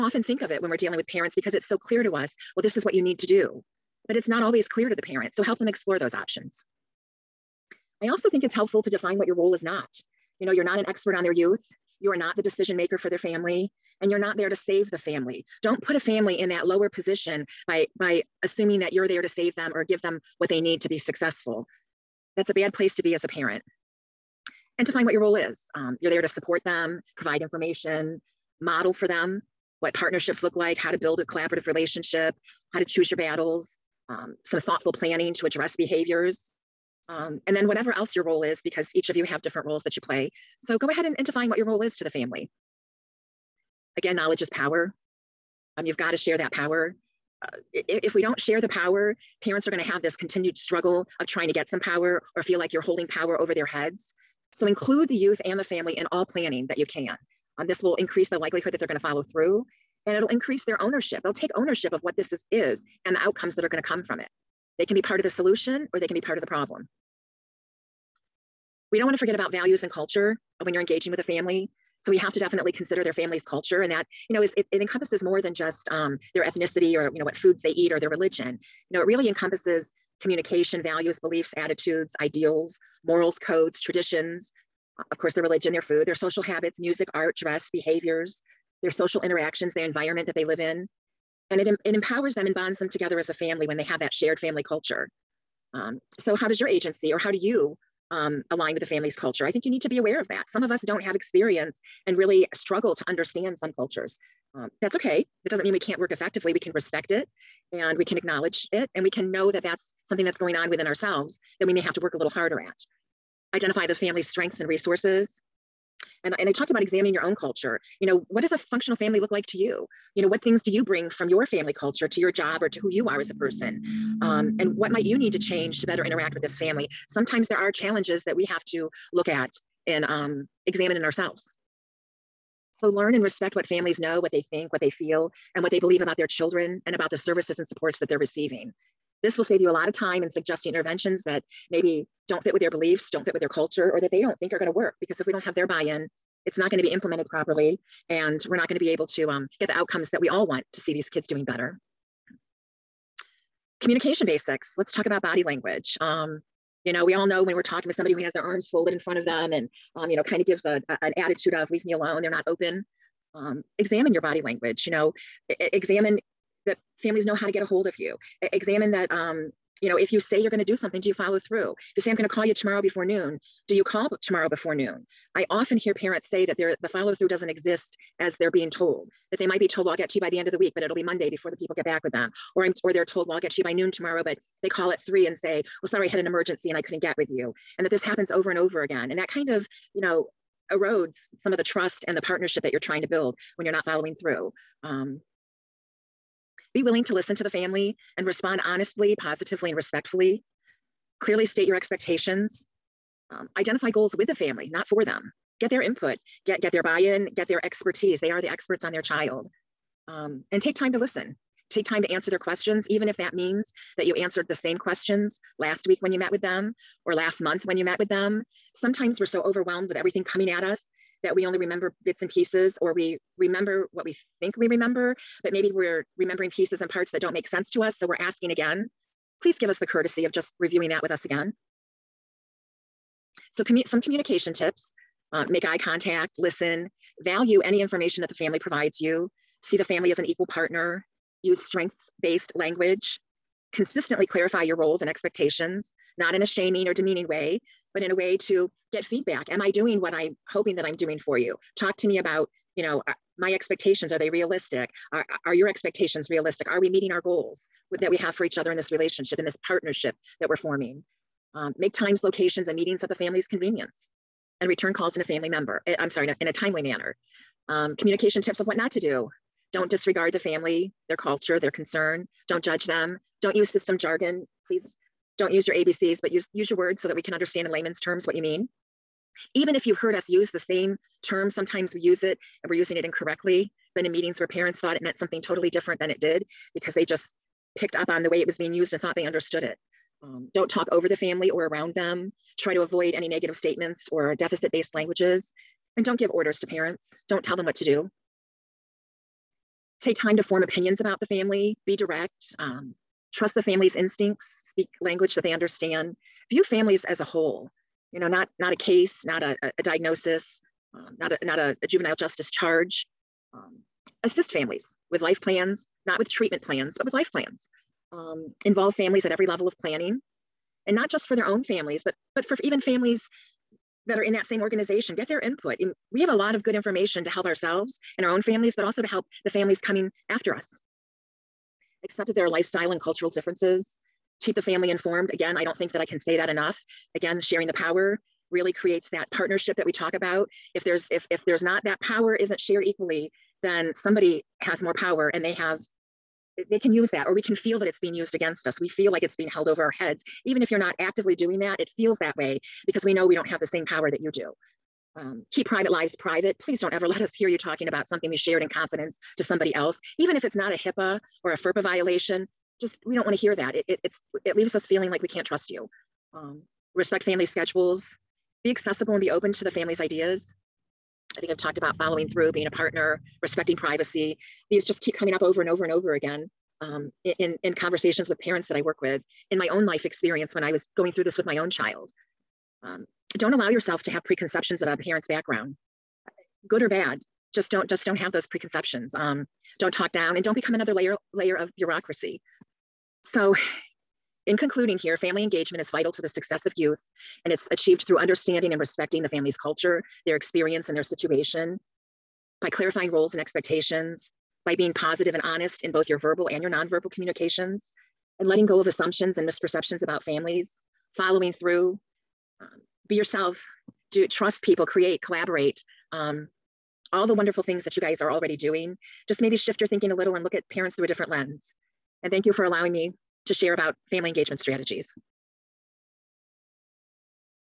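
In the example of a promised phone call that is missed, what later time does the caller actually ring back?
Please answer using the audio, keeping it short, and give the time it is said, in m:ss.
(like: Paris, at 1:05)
3, at 3:04.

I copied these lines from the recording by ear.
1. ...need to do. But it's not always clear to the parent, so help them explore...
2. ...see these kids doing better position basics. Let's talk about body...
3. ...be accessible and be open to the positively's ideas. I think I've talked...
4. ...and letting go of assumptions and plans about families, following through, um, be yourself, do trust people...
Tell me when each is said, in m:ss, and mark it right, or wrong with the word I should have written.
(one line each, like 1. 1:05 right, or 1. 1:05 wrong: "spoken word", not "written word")
1. 0:03 right
2. 2:30 wrong: "communication", not "position"
3. 6:08 wrong: "family", not "positively"
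4. 6:48 wrong: "misperceptions", not "plans".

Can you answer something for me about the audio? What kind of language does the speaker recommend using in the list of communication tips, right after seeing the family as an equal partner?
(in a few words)
Strengths-based language.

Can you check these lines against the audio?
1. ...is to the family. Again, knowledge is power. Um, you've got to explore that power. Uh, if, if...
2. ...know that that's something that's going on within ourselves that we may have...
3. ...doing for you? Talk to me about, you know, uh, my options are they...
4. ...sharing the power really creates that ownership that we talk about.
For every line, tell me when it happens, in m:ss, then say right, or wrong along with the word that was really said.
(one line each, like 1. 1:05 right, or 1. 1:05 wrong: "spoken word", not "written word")
1. 0:41 wrong: "share", not "explore"
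2. 1:49 right
3. 4:10 wrong: "expectations", not "options"
4. 5:37 wrong: "partnership", not "ownership".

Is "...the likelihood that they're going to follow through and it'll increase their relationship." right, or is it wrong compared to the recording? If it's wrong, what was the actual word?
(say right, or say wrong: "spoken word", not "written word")
wrong: "ownership", not "relationship".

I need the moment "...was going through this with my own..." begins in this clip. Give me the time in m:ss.
6:20.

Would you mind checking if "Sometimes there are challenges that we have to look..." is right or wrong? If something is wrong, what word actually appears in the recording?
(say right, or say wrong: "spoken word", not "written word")
right.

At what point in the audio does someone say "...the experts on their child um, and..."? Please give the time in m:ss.
3:28.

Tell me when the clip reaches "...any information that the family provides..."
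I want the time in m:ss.
3:57.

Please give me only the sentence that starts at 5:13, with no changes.
Um, assist families with life plans, not with treatment plans, but with life plans.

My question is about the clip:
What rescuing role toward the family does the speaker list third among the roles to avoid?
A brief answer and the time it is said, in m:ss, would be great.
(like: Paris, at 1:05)
Save the family, at 0:14.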